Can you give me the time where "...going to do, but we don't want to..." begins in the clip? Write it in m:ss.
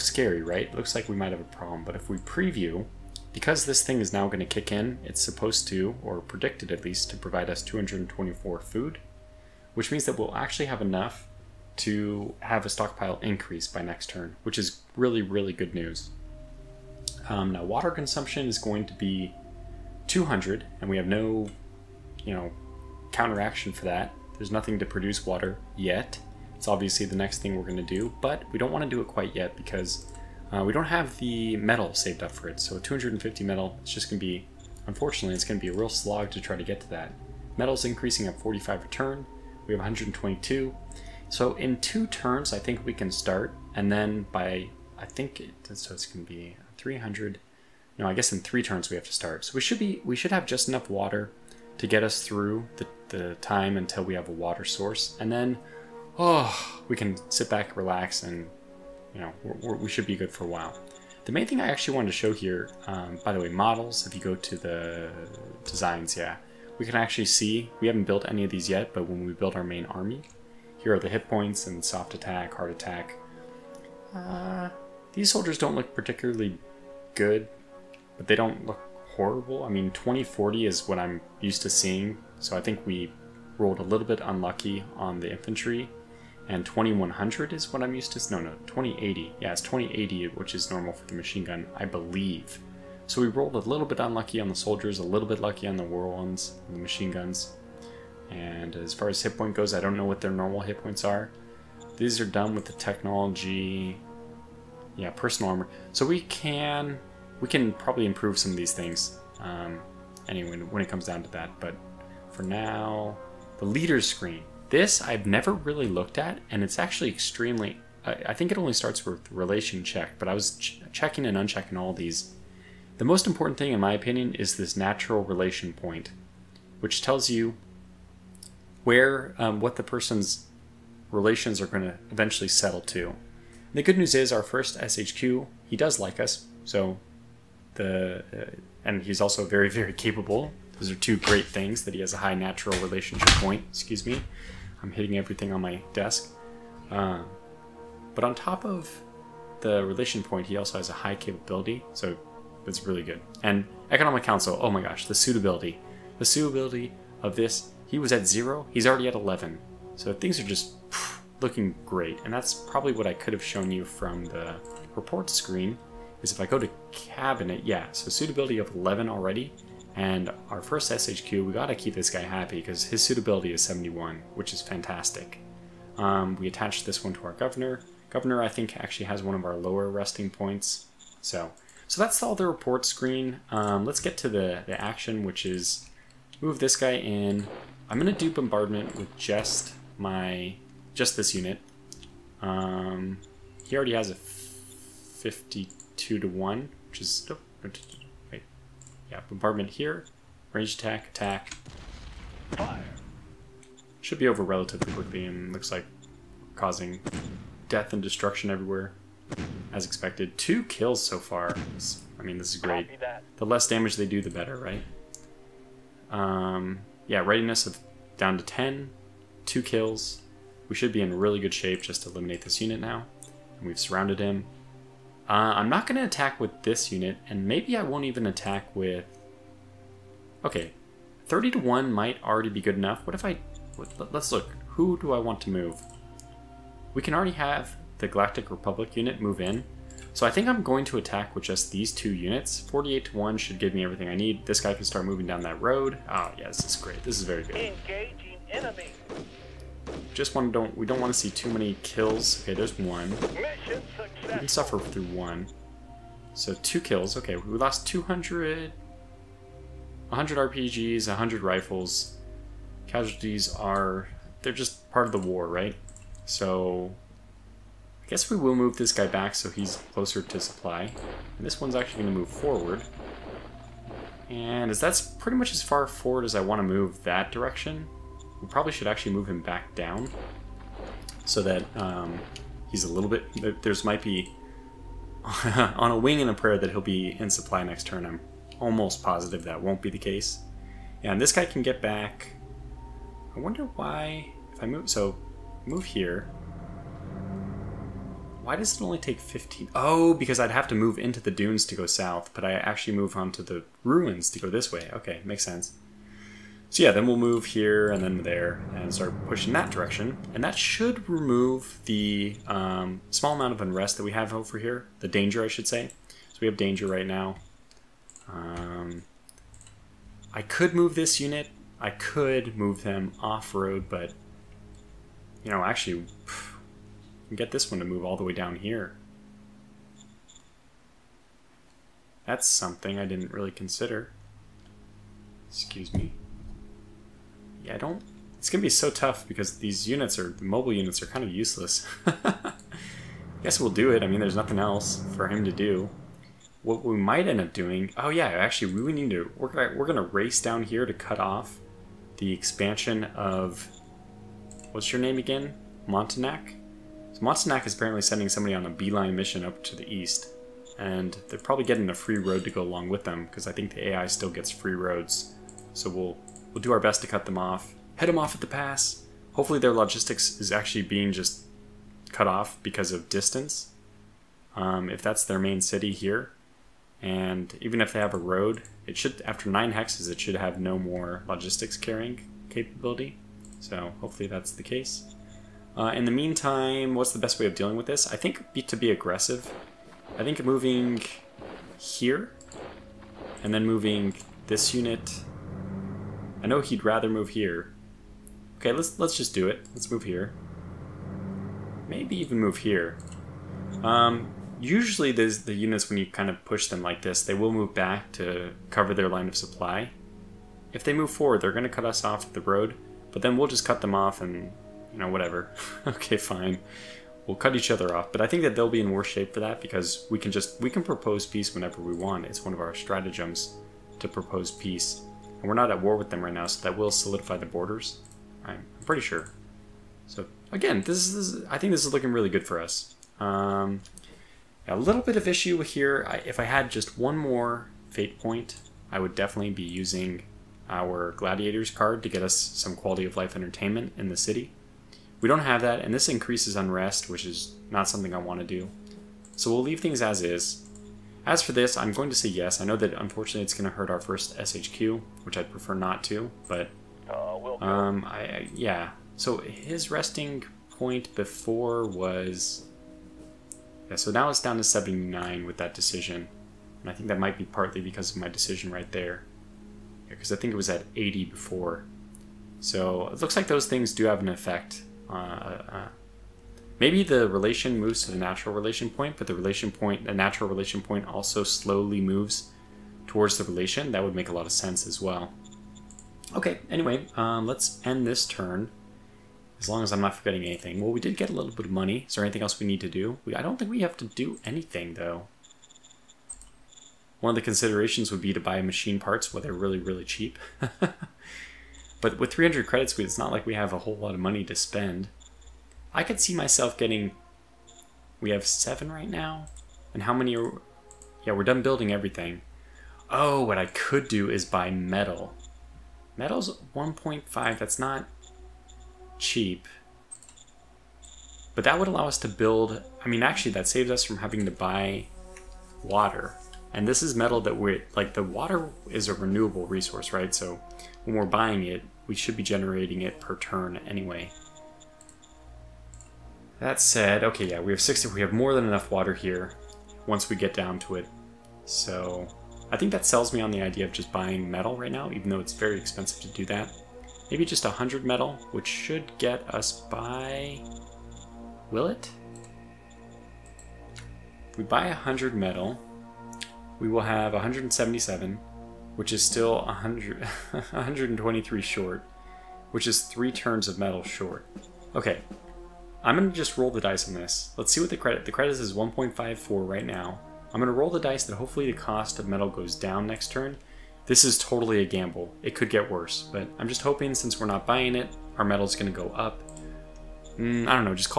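0:27.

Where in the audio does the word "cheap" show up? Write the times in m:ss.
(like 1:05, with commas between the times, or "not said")
8:20, 8:39.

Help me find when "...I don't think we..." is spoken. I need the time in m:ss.
8:13.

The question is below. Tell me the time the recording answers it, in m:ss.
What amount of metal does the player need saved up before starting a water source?
0:32.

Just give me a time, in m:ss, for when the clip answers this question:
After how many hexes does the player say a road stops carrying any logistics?
6:19.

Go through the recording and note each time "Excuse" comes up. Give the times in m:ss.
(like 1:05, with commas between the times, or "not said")
2:23, 5:35.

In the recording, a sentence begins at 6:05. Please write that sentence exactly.
So we'll we'll do our best to cut them off, head them off at the pass.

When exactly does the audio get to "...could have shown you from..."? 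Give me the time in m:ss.
2:43.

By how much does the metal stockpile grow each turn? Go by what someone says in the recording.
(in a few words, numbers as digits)
45.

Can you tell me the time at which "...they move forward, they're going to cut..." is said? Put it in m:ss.
6:50.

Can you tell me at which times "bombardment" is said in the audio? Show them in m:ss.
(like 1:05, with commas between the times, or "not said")
3:08, 3:19.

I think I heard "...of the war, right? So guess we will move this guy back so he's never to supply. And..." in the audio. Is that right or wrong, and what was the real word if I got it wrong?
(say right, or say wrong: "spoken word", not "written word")
wrong: "closer", not "never".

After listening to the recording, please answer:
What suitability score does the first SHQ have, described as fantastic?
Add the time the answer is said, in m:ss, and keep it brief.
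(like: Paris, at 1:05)
71, at 2:53.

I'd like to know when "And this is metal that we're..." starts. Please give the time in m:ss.
8:46.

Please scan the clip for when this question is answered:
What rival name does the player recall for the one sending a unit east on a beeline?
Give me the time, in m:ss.
5:55.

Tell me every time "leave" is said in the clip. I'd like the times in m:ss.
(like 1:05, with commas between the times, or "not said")
7:29.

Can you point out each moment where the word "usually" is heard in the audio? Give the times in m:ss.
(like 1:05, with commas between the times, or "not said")
6:44.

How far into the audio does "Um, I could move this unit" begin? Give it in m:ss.
5:18.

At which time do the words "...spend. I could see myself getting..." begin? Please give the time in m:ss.
8:24.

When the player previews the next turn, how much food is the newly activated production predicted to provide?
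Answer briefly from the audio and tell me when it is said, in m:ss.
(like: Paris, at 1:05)
224, at 0:07.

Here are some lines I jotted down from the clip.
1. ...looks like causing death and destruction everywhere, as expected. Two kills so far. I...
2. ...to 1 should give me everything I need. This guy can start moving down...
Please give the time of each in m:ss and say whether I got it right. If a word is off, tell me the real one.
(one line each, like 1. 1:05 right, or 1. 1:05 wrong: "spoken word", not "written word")
1. 3:25 right
2. 4:03 right.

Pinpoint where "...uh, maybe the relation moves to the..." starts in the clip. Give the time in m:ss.
7:55.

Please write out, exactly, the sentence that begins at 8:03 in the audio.
That would make a lot of sense as well.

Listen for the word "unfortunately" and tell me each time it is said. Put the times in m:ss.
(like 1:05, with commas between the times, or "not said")
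0:34, 7:32.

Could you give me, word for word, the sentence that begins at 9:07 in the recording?
Maybe just 100 metal, which should get us by...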